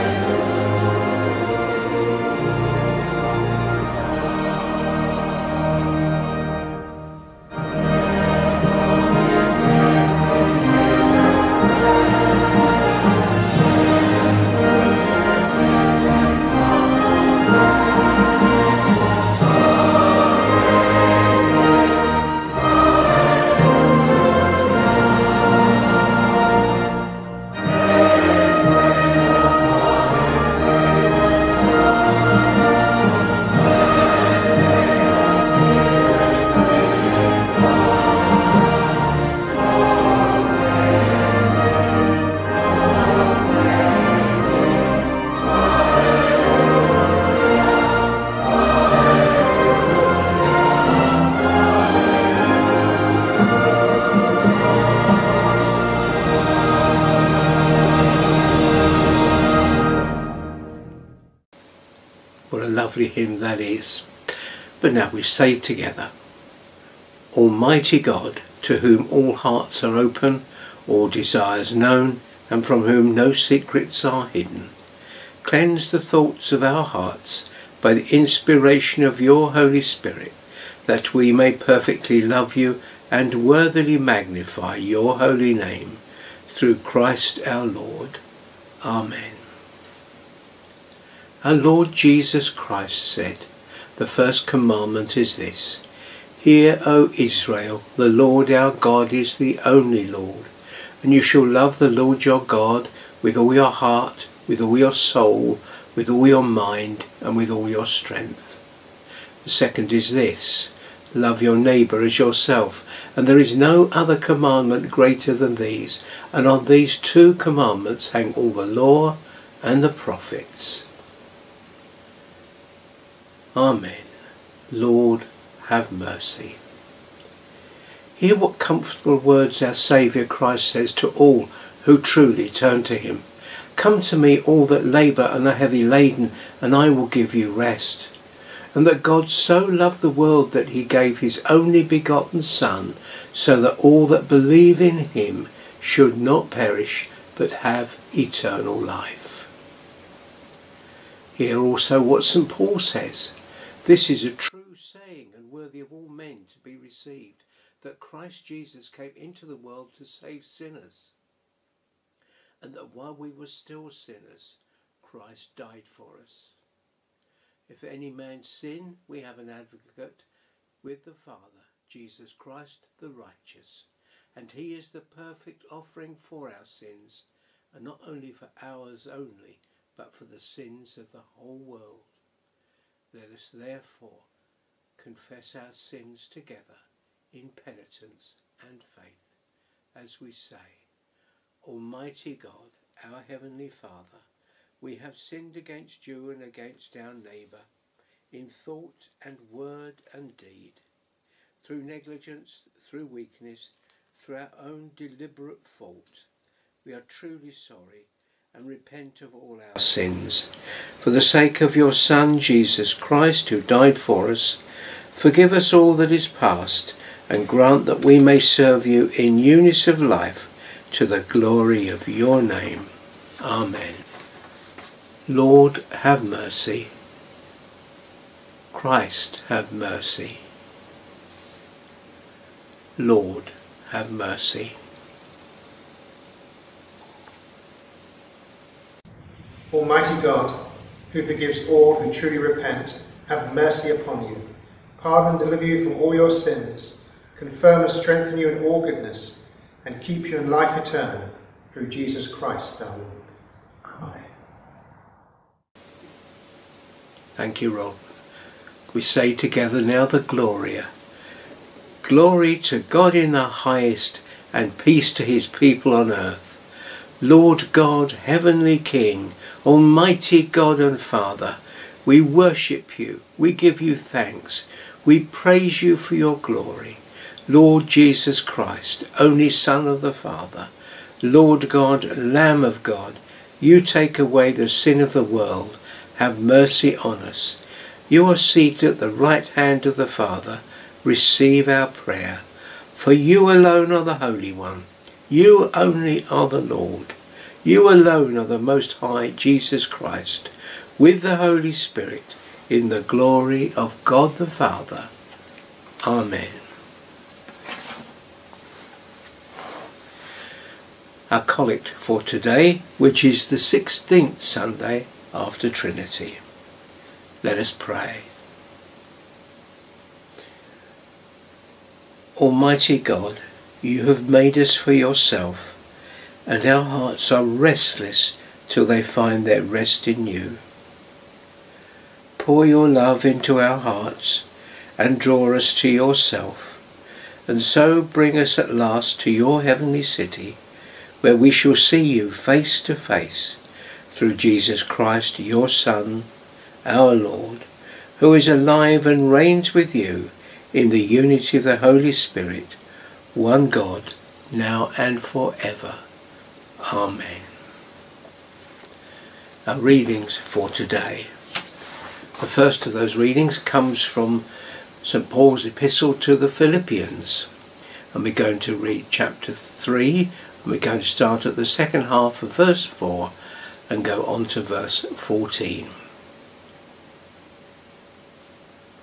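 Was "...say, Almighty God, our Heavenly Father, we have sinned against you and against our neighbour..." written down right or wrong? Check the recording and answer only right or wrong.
right.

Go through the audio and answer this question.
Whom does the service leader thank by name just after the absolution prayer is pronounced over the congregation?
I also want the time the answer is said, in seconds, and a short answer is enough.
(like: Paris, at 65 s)
Rob, at 257 s.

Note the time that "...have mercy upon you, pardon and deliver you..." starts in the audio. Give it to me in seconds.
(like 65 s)
243 s.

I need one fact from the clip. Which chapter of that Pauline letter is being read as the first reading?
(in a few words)
Chapter 3.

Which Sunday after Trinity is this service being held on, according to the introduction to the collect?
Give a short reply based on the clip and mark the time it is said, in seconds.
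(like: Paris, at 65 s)
16th Sunday after Trinity, at 313 s.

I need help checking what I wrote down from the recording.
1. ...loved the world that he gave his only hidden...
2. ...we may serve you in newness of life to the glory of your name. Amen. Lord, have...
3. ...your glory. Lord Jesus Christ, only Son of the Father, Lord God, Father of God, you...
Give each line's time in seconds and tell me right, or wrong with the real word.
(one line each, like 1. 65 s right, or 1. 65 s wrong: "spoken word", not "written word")
1. 139 s wrong: "begotten", not "hidden"
2. 218 s right
3. 276 s wrong: "Lamb", not "Father".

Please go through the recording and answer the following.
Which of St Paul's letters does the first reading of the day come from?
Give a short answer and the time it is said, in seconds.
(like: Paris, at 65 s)
Philippians, at 366 s.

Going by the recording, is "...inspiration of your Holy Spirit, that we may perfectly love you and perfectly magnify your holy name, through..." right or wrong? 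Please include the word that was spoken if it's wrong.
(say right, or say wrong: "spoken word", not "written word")
wrong: "worthily", not "perfectly".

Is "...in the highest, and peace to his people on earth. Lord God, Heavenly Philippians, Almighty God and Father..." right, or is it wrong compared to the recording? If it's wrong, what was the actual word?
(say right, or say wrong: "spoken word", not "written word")
wrong: "King", not "Philippians".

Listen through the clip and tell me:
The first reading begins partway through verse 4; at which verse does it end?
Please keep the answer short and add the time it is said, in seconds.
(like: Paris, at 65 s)
14, at 374 s.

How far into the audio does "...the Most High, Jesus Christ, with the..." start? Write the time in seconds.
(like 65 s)
298 s.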